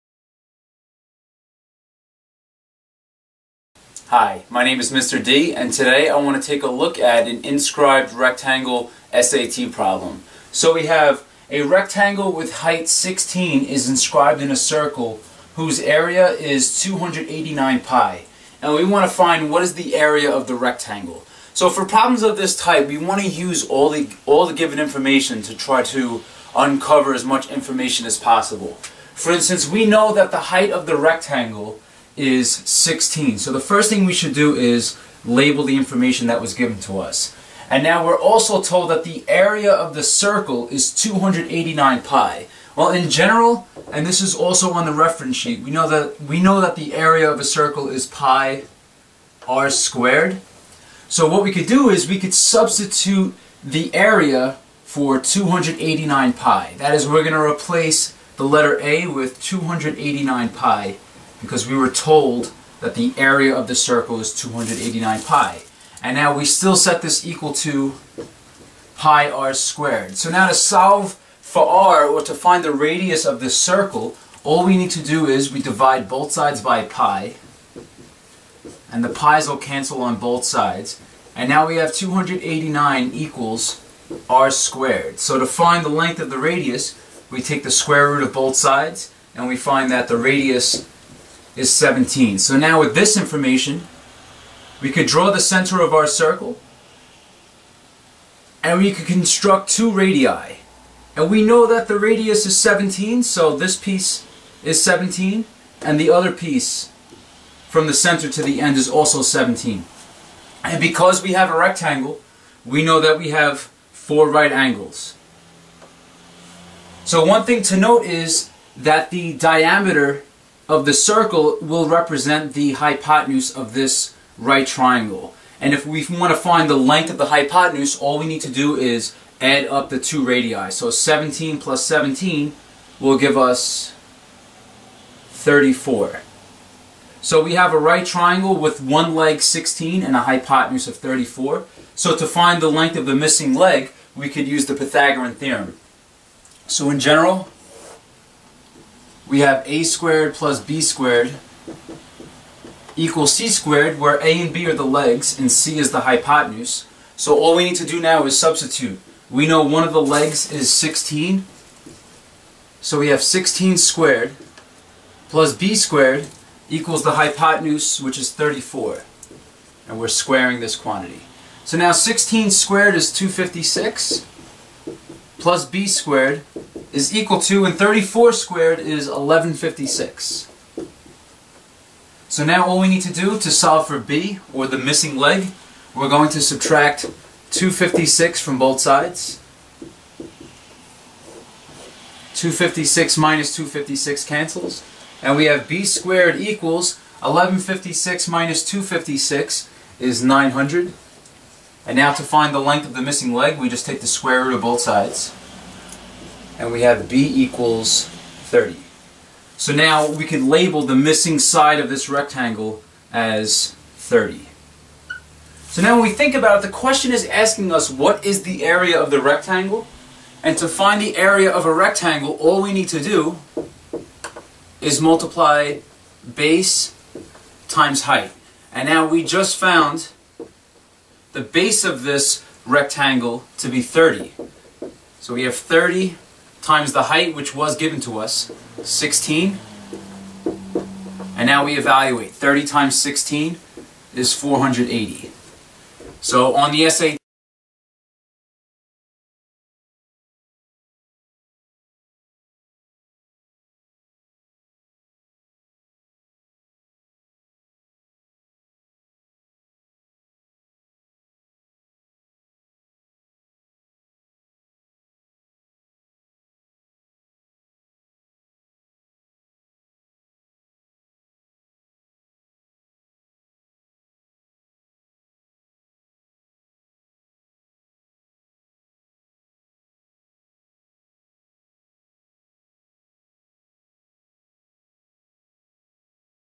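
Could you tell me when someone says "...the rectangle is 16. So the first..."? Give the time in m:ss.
0:30.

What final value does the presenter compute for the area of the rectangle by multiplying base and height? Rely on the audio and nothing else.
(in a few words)
480.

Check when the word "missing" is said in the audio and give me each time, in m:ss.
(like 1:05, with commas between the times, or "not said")
2:23, 3:04, 3:23, 3:30.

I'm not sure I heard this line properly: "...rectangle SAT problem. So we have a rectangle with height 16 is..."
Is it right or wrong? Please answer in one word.
right.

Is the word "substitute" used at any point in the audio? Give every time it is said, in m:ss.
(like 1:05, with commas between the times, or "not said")
0:52, 2:38.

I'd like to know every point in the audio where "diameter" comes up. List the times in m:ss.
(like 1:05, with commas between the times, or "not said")
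1:59.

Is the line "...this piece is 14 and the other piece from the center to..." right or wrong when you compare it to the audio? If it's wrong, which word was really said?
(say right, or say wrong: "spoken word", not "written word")
wrong: "17", not "14".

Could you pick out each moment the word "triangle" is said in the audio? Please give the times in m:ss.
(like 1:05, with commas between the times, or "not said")
2:04, 2:18.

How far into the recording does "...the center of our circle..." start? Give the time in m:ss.
1:35.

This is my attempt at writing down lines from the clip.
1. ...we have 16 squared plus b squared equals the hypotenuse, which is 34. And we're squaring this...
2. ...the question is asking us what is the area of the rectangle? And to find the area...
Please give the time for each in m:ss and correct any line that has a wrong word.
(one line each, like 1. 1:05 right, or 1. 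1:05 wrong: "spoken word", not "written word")
1. 2:42 right
2. 3:36 right.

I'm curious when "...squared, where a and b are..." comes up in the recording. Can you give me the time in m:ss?
2:33.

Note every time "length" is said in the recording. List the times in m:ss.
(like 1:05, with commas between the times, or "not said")
1:25, 2:06, 2:22, 3:22.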